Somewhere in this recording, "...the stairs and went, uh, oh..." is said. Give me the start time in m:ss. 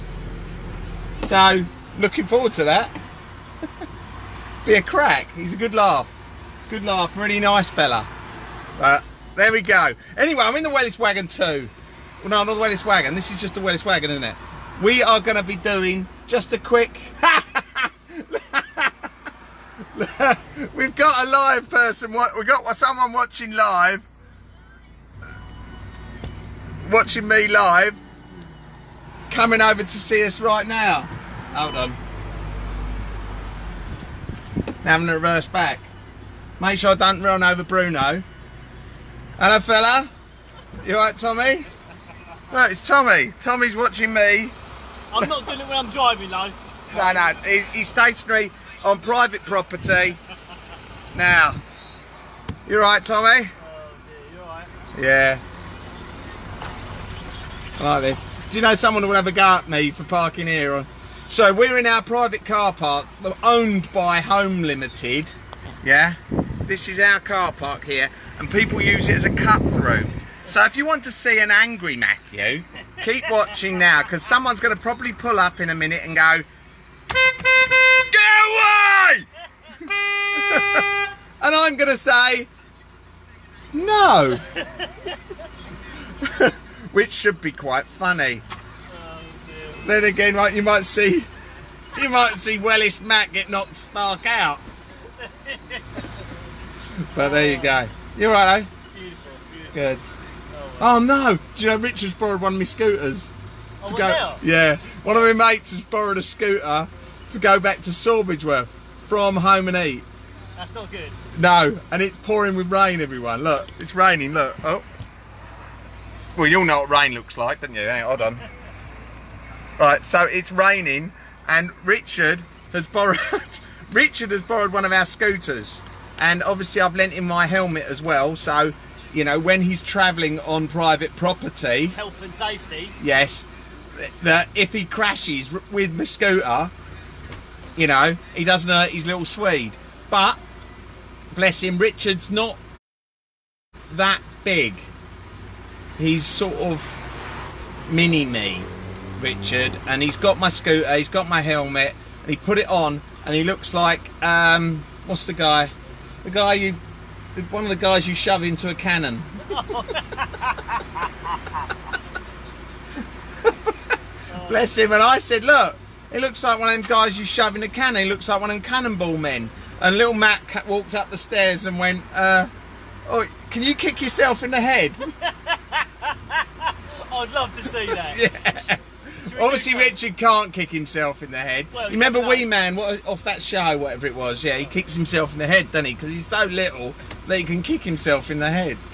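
2:51.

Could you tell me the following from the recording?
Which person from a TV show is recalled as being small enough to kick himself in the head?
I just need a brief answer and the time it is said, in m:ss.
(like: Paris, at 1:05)
Wee Man, at 3:02.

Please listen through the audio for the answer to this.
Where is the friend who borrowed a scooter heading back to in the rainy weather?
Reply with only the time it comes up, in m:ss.
1:47.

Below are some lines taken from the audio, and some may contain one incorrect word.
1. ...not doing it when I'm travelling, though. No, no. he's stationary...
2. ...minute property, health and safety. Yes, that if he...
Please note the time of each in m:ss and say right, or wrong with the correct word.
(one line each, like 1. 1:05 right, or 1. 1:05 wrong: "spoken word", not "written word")
1. 0:45 wrong: "driving", not "travelling"
2. 2:10 wrong: "private", not "minute".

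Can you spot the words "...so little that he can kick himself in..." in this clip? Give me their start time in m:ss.
3:06.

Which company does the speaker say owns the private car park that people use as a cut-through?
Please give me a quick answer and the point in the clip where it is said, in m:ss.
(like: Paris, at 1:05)
Home Limited, at 1:04.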